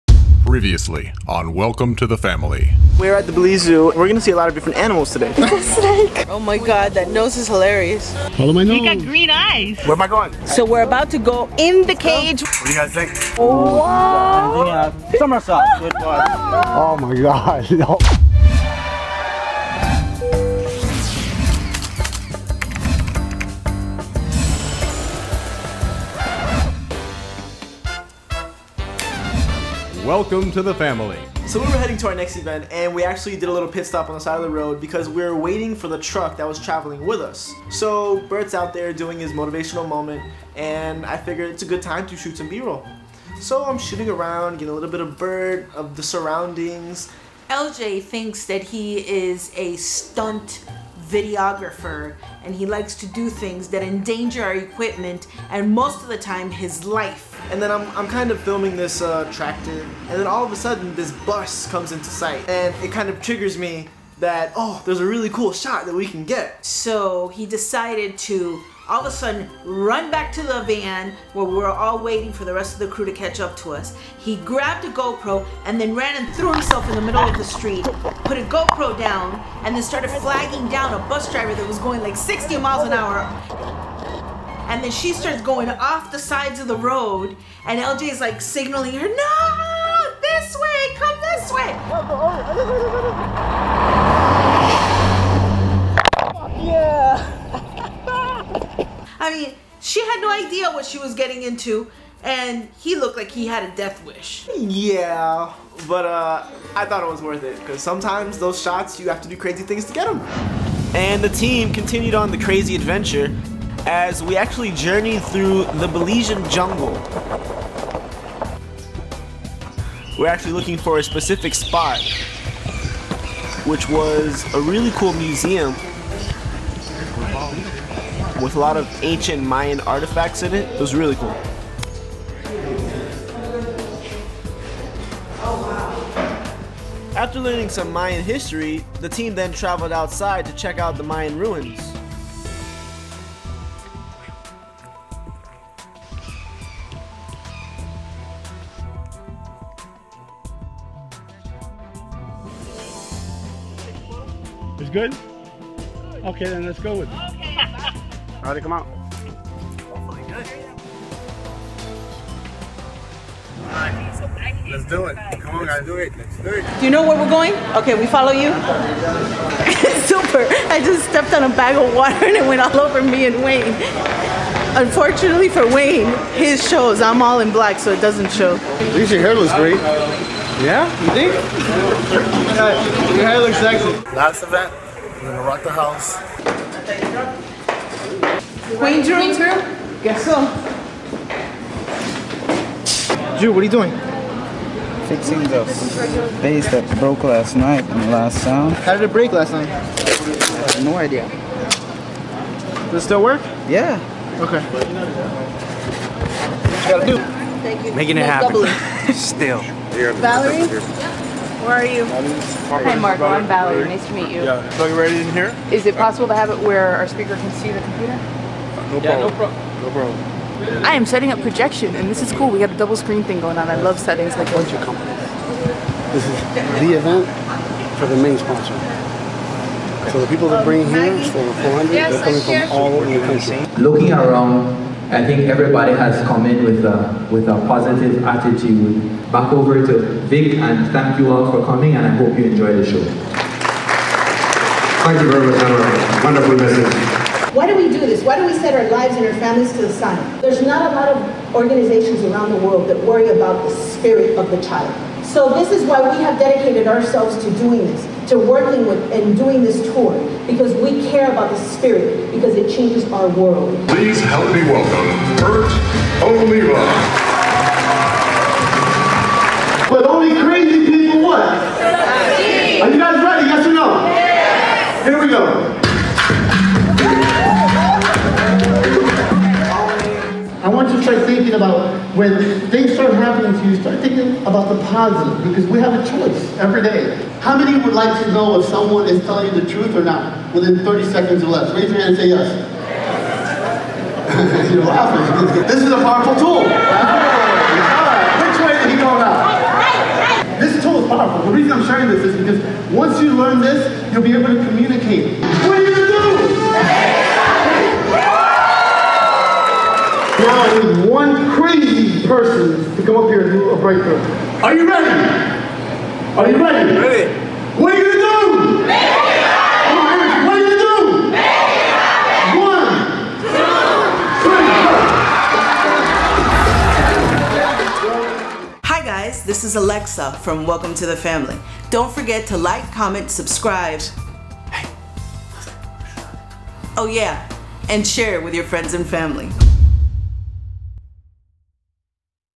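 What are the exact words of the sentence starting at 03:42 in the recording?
We got a double screen thing going on.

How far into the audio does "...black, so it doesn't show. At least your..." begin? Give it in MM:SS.
02:57.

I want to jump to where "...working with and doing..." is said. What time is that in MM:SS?
04:18.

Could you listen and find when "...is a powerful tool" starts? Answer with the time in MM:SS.
04:55.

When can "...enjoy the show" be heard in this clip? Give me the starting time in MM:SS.
04:02.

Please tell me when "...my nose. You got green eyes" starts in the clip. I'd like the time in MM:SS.
00:08.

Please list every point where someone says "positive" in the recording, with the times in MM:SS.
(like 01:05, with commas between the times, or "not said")
03:57, 04:44.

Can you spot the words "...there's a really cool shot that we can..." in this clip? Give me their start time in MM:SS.
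01:04.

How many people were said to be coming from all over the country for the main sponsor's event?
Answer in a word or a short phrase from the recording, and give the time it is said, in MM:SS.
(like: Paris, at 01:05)
400, at 03:51.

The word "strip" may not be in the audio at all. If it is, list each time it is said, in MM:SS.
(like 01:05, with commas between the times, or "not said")
not said.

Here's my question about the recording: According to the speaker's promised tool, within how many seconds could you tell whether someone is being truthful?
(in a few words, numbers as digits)
30.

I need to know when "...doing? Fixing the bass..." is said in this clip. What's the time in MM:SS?
03:13.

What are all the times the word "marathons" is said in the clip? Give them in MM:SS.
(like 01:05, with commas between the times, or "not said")
not said.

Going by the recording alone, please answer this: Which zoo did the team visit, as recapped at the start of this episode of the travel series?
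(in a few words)
Belize Zoo.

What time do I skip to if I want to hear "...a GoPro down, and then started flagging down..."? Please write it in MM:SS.
01:18.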